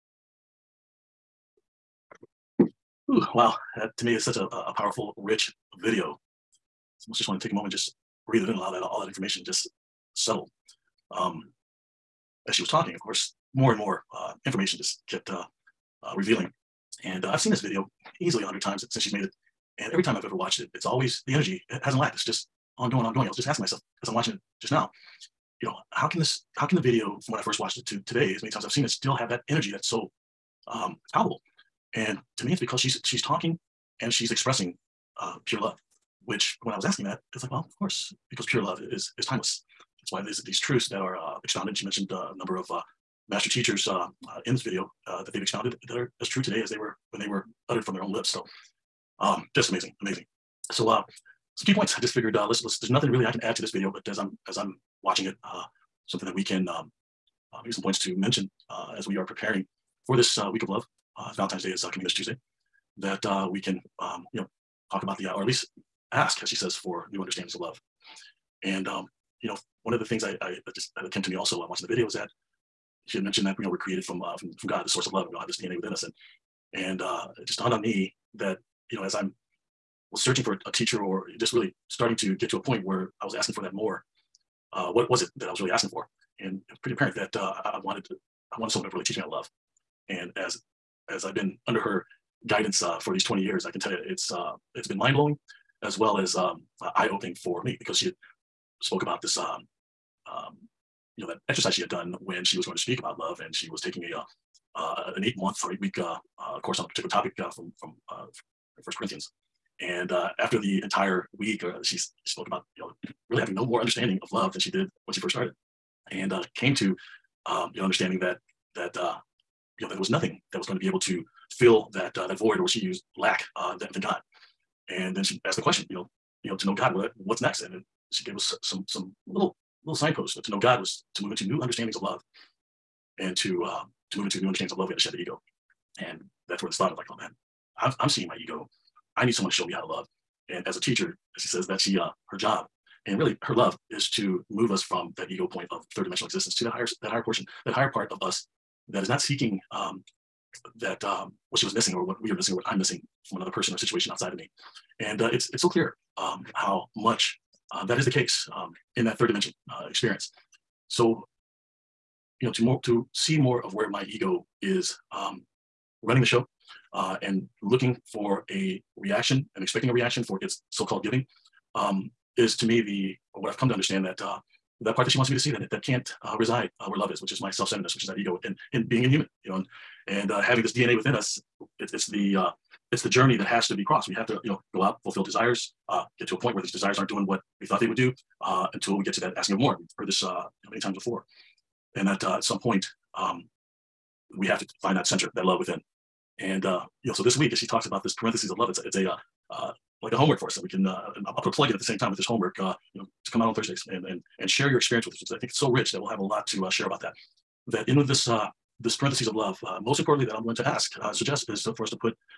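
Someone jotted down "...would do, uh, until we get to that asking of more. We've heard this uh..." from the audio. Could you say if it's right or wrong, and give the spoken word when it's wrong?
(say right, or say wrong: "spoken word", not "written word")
right.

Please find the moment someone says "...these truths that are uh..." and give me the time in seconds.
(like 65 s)
40 s.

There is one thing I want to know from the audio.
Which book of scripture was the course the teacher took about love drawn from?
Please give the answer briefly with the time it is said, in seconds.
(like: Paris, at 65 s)
First Corinthians, at 108 s.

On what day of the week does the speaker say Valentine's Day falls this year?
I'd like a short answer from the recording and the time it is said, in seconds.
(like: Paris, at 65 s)
Tuesday, at 62 s.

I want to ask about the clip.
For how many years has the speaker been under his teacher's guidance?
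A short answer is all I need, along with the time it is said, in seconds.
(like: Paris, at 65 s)
20, at 93 s.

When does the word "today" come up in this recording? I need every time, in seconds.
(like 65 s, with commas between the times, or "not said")
28 s, 46 s.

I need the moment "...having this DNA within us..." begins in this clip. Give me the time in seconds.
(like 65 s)
180 s.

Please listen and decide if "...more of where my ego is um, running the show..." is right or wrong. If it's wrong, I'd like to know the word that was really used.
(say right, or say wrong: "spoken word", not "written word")
right.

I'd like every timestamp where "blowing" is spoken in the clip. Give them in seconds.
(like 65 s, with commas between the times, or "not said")
95 s.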